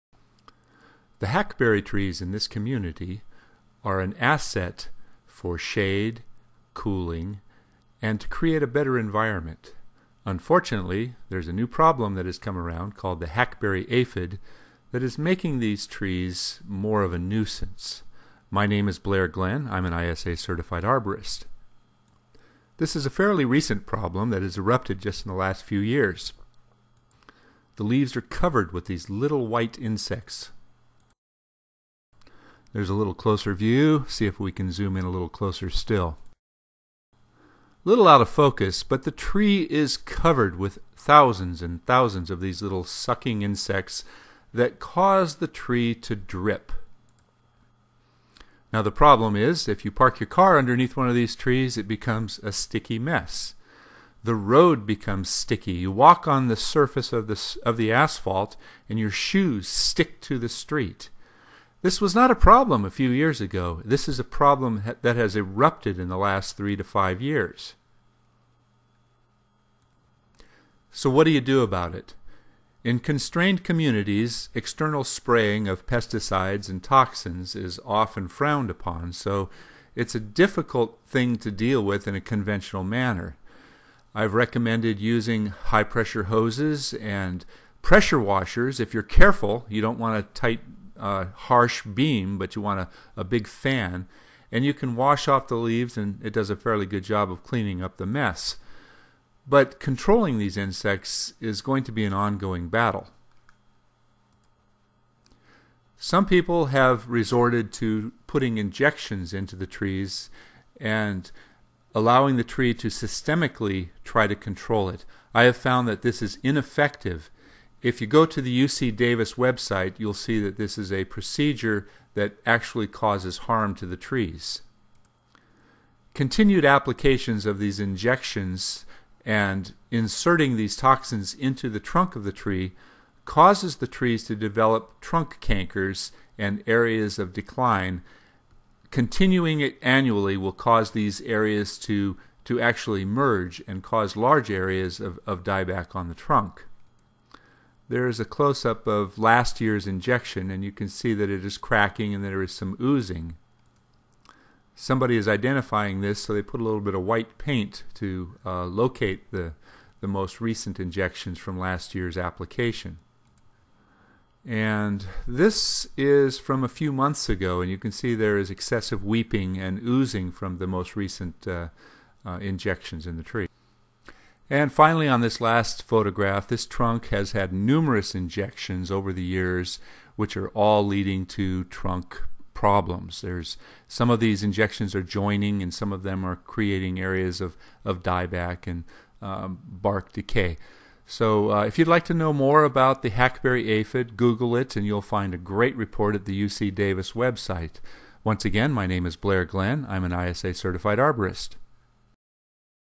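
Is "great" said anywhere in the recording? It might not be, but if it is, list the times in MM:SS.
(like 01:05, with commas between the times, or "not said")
03:15.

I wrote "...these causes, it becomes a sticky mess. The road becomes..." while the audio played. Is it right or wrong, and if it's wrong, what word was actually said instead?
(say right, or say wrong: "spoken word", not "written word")
wrong: "trees", not "causes".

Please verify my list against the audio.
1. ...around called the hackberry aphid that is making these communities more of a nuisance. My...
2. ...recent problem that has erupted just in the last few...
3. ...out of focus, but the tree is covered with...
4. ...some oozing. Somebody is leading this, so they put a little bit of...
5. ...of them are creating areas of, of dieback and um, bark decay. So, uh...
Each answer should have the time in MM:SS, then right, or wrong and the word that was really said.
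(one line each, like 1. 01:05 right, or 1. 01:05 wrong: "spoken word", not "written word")
1. 00:12 wrong: "trees", not "communities"
2. 00:23 right
3. 00:38 right
4. 02:32 wrong: "identifying", not "leading"
5. 03:05 right.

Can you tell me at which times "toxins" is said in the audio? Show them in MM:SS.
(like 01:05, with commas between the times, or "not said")
01:16, 02:10.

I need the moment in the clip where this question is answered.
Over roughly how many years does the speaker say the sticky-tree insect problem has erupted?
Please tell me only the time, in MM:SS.
01:06.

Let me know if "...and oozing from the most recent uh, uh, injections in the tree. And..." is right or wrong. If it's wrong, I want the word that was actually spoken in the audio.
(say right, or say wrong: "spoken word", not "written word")
right.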